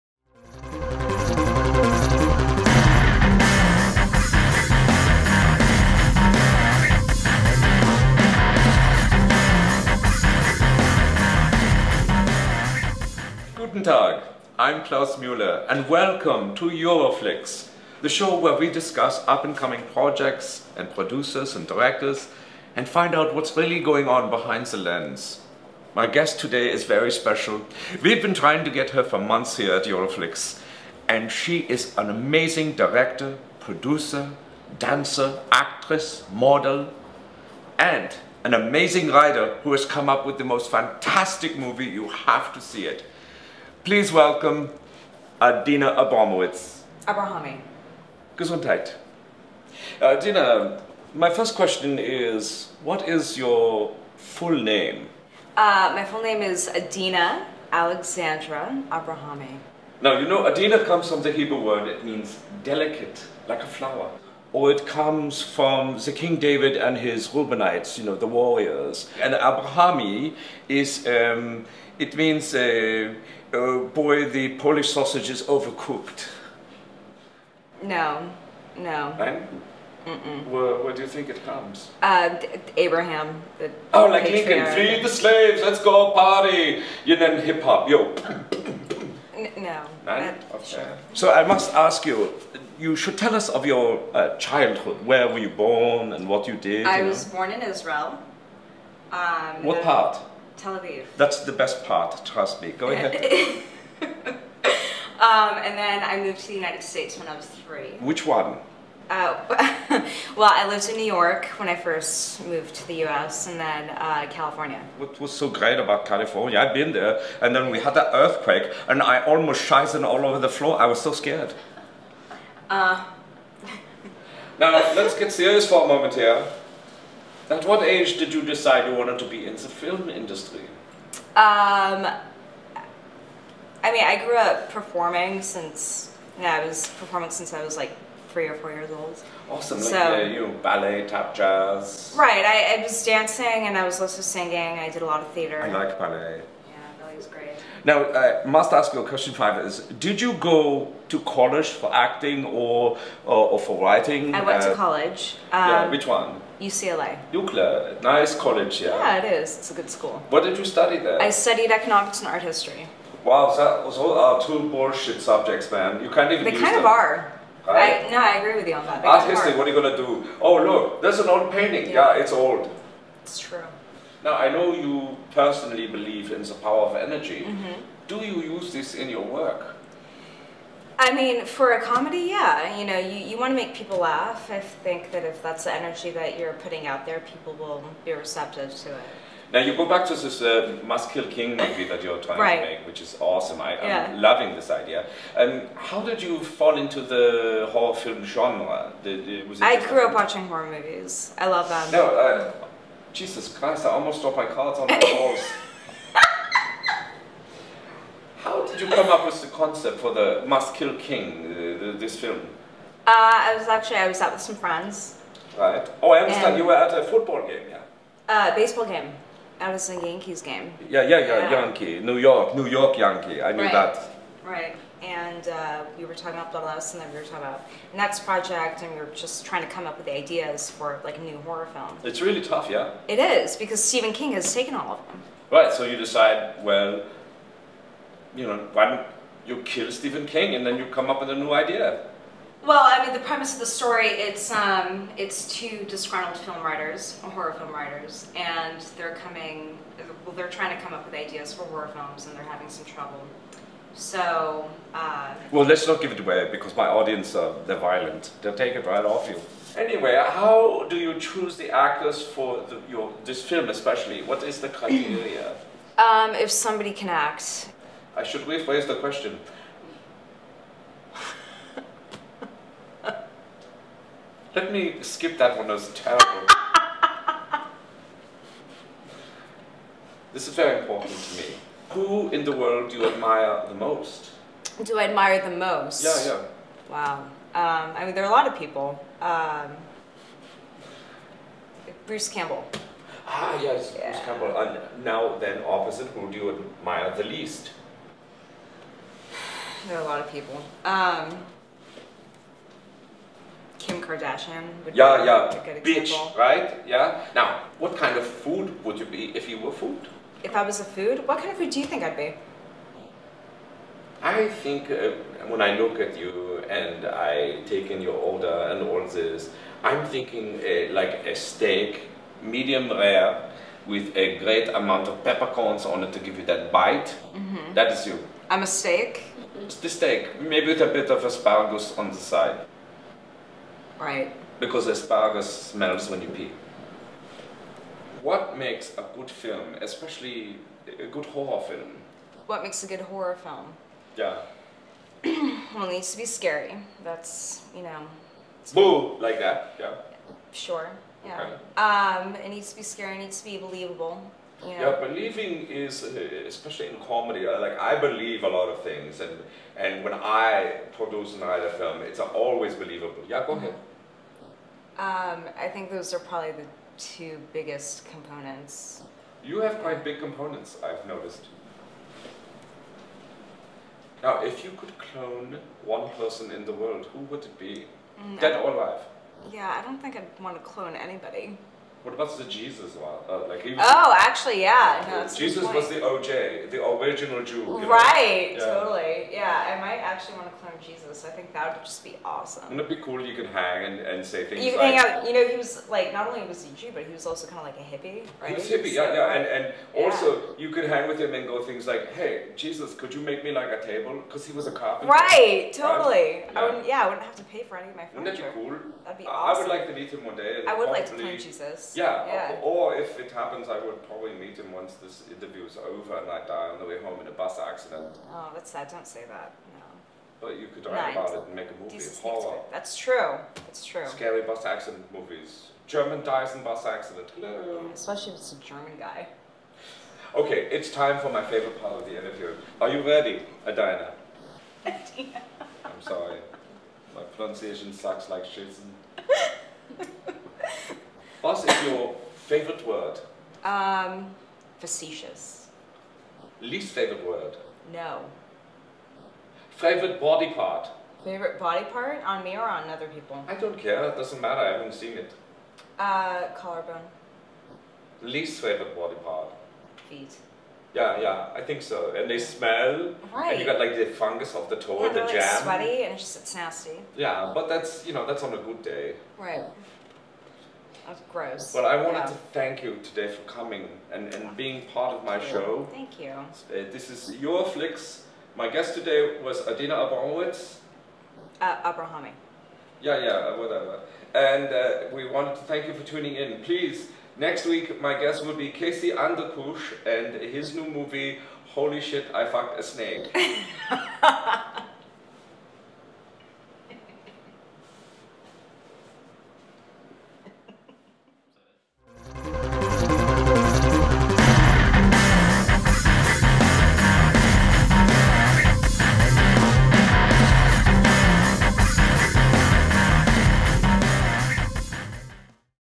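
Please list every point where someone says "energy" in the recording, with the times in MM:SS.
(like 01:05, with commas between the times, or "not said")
02:56, 03:05.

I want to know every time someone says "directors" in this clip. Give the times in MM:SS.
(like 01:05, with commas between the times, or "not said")
00:21, 00:32.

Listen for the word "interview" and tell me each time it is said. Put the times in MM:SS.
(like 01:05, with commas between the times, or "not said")
06:55, 07:12.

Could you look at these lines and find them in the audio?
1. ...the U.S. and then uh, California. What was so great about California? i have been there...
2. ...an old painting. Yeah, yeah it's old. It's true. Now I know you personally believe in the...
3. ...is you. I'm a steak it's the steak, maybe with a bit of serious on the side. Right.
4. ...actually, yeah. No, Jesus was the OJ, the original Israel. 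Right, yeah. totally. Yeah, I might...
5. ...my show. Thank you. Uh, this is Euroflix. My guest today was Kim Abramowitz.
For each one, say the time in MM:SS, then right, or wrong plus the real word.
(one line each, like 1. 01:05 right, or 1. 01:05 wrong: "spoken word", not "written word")
1. 01:52 right
2. 02:51 right
3. 05:27 wrong: "asparagus", not "serious"
4. 06:24 wrong: "Jew", not "Israel"
5. 07:55 wrong: "Adina", not "Kim".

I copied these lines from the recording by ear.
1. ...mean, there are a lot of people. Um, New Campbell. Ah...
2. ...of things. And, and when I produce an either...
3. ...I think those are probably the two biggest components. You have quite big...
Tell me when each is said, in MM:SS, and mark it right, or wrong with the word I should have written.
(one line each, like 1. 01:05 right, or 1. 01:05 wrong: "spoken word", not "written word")
1. 04:48 wrong: "Bruce", not "New"
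2. 05:58 right
3. 06:05 right.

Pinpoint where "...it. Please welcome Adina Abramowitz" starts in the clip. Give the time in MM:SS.
00:42.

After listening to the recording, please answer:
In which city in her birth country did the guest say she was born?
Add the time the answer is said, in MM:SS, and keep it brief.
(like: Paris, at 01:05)
Tel Aviv, at 01:40.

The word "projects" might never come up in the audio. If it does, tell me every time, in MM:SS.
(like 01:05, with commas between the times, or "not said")
00:19, 03:48.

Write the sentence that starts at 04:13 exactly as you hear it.
So, uh, Well, let's not give it away because my audience, are, they're violent.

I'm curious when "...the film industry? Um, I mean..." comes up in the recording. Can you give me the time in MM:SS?
02:09.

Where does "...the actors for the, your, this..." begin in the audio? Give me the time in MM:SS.
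04:21.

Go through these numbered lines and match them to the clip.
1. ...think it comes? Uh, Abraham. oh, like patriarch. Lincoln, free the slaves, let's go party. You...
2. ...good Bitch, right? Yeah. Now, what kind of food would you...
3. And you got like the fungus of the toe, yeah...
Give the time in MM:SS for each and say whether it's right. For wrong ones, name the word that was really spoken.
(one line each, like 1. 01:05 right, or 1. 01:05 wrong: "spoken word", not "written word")
1. 01:21 right
2. 05:05 right
3. 07:43 right.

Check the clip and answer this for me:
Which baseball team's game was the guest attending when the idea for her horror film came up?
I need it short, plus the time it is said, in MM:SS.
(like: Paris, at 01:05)
Yankees, at 03:39.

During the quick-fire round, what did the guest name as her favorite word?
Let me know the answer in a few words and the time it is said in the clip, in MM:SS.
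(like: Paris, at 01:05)
Facetious, at 07:24.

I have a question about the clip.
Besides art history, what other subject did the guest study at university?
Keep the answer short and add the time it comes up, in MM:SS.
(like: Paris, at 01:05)
Economics, at 02:41.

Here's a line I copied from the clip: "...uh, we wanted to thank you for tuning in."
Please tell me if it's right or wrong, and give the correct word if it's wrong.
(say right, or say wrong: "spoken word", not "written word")
right.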